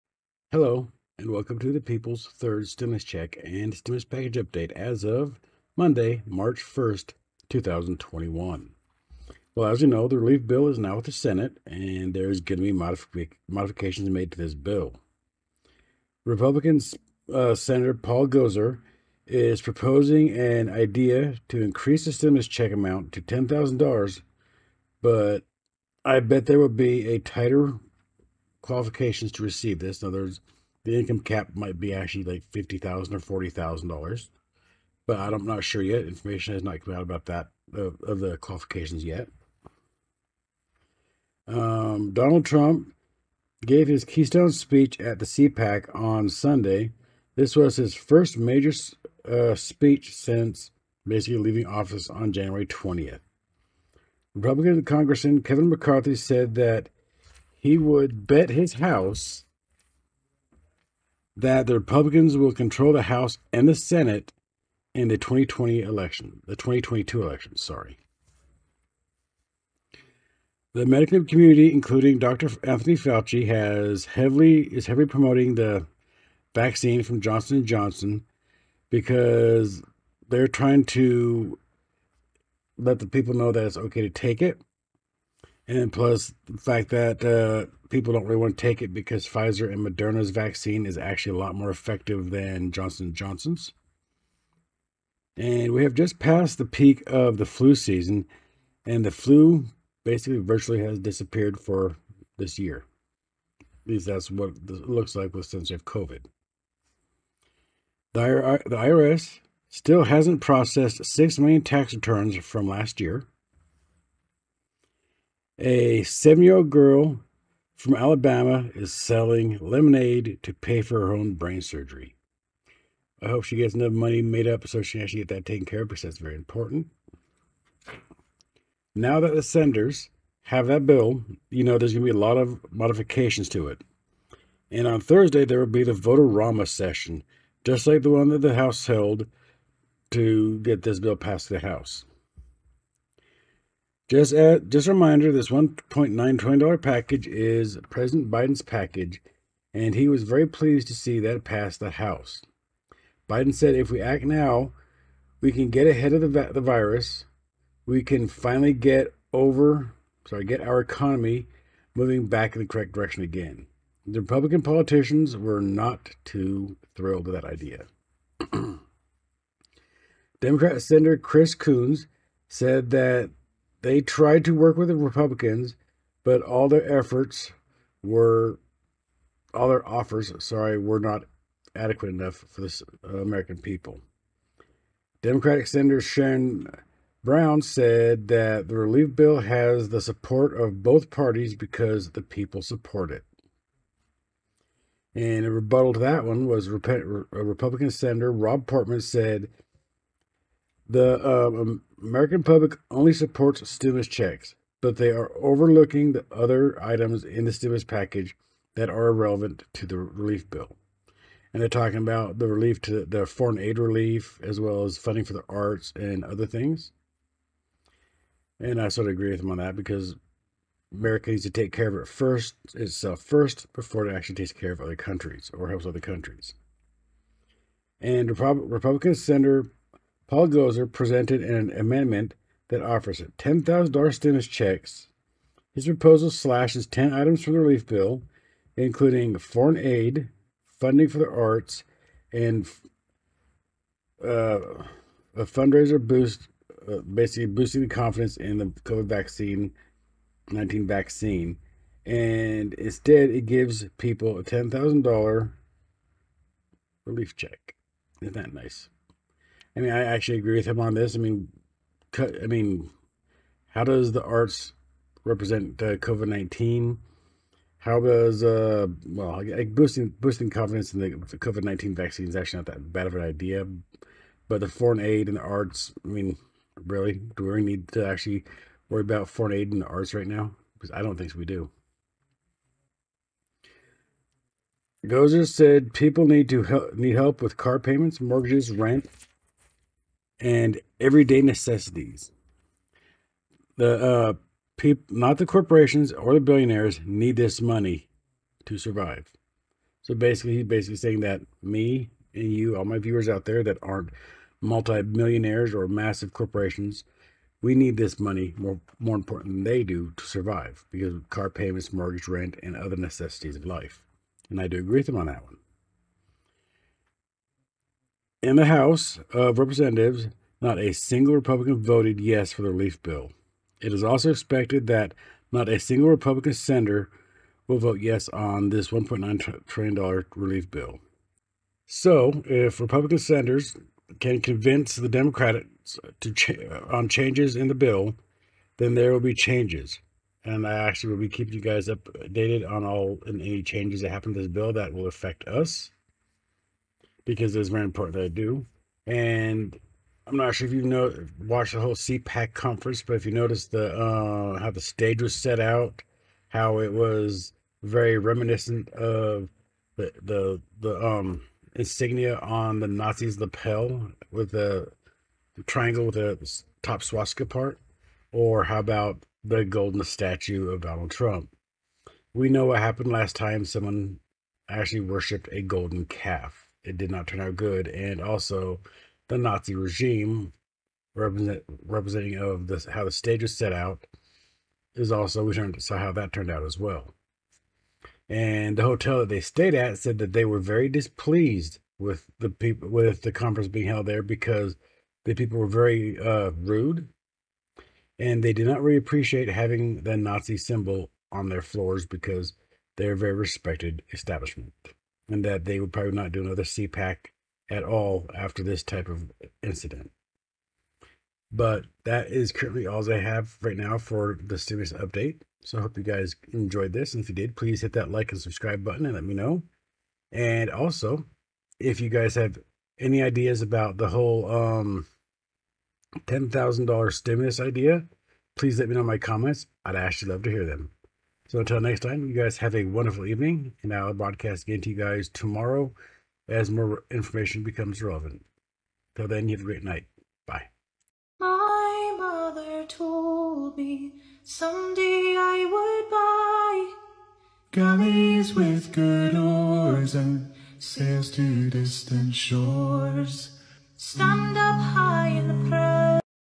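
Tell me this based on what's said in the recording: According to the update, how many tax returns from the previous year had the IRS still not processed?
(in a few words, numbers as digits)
6 million.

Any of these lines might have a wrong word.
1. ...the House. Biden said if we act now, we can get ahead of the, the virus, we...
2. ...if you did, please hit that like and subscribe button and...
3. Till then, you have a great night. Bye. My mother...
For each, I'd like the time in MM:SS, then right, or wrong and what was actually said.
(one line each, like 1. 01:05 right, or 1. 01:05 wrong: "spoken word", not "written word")
1. 02:31 right
2. 06:57 right
3. 07:19 right.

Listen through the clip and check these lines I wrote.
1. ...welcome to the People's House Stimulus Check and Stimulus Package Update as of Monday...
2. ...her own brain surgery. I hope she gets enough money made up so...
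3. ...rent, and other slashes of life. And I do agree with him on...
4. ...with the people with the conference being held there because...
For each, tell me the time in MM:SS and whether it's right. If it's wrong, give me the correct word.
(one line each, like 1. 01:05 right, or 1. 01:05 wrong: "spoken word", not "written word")
1. 00:01 wrong: "Third", not "House"
2. 02:01 right
3. 05:12 wrong: "necessities", not "slashes"
4. 06:31 right.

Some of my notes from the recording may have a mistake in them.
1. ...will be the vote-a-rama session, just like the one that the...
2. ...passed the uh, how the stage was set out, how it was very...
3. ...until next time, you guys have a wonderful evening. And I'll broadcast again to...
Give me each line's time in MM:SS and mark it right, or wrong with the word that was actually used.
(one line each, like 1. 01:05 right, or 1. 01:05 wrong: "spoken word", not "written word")
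1. 02:15 right
2. 05:53 wrong: "noticed", not "passed"
3. 07:11 right.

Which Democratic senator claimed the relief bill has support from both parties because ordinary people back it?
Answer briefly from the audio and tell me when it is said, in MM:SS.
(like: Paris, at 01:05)
Sherrod Brown, at 03:05.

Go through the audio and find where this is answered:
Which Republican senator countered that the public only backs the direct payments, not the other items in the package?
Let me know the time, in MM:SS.
03:18.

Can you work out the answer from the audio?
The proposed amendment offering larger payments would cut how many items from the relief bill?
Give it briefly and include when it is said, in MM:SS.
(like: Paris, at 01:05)
10, at 03:56.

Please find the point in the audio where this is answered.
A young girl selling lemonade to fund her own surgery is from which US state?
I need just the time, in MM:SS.
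01:57.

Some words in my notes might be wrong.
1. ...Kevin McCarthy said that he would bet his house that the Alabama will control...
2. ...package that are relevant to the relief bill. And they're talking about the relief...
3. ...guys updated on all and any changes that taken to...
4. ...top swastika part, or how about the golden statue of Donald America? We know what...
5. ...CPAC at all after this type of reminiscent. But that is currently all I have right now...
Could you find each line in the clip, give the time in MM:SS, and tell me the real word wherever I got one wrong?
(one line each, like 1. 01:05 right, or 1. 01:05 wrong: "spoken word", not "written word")
1. 00:55 wrong: "Republicans", not "Alabama"
2. 03:27 right
3. 05:41 wrong: "happen", not "taken"
4. 06:06 wrong: "Trump", not "America"
5. 06:46 wrong: "incident", not "reminiscent".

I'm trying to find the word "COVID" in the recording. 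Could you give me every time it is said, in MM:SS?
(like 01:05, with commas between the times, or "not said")
01:45, 04:08, 04:25, 04:31.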